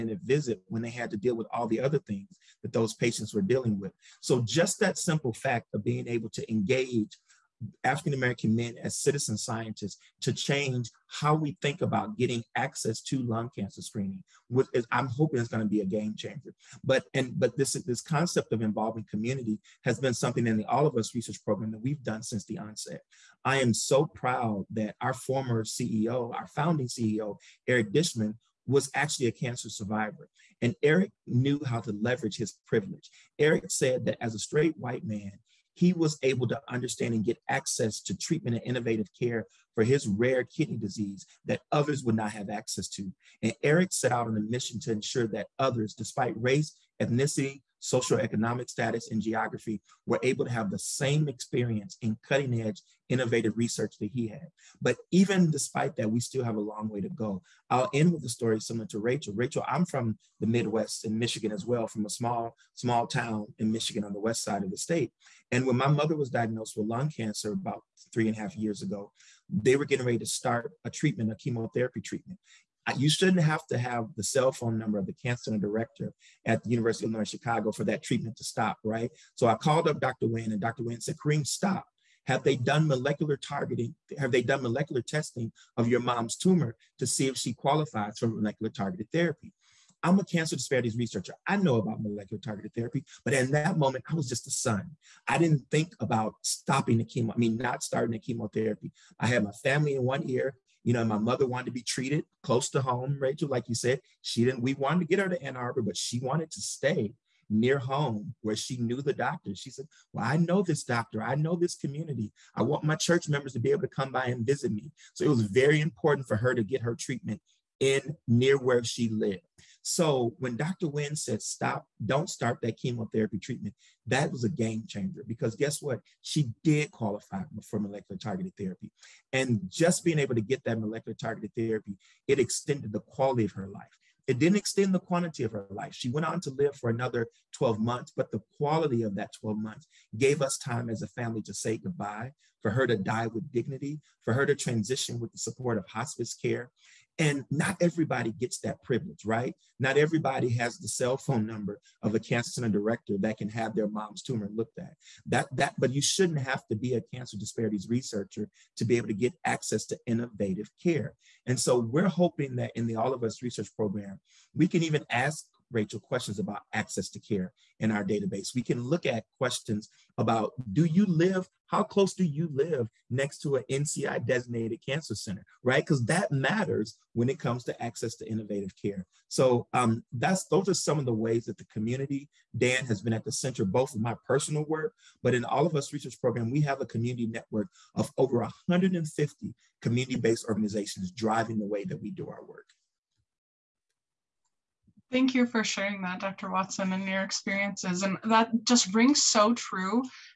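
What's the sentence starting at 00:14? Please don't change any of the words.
is, I'm hoping it's going to be a game changer.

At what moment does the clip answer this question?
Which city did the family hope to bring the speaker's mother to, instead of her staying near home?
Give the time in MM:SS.
01:45.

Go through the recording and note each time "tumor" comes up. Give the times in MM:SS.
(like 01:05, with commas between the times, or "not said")
01:26, 02:34.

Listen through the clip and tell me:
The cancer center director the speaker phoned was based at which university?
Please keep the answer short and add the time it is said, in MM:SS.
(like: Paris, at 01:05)
University of Illinois Chicago, at 01:16.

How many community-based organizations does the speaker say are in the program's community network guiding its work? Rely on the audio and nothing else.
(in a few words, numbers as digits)
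Over 150.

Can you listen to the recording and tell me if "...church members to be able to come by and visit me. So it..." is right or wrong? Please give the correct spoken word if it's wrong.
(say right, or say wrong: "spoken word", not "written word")
right.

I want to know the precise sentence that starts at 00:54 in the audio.
But even despite that, we still have a long way to go.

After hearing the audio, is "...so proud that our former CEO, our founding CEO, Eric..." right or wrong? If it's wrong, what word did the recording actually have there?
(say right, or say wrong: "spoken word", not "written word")
right.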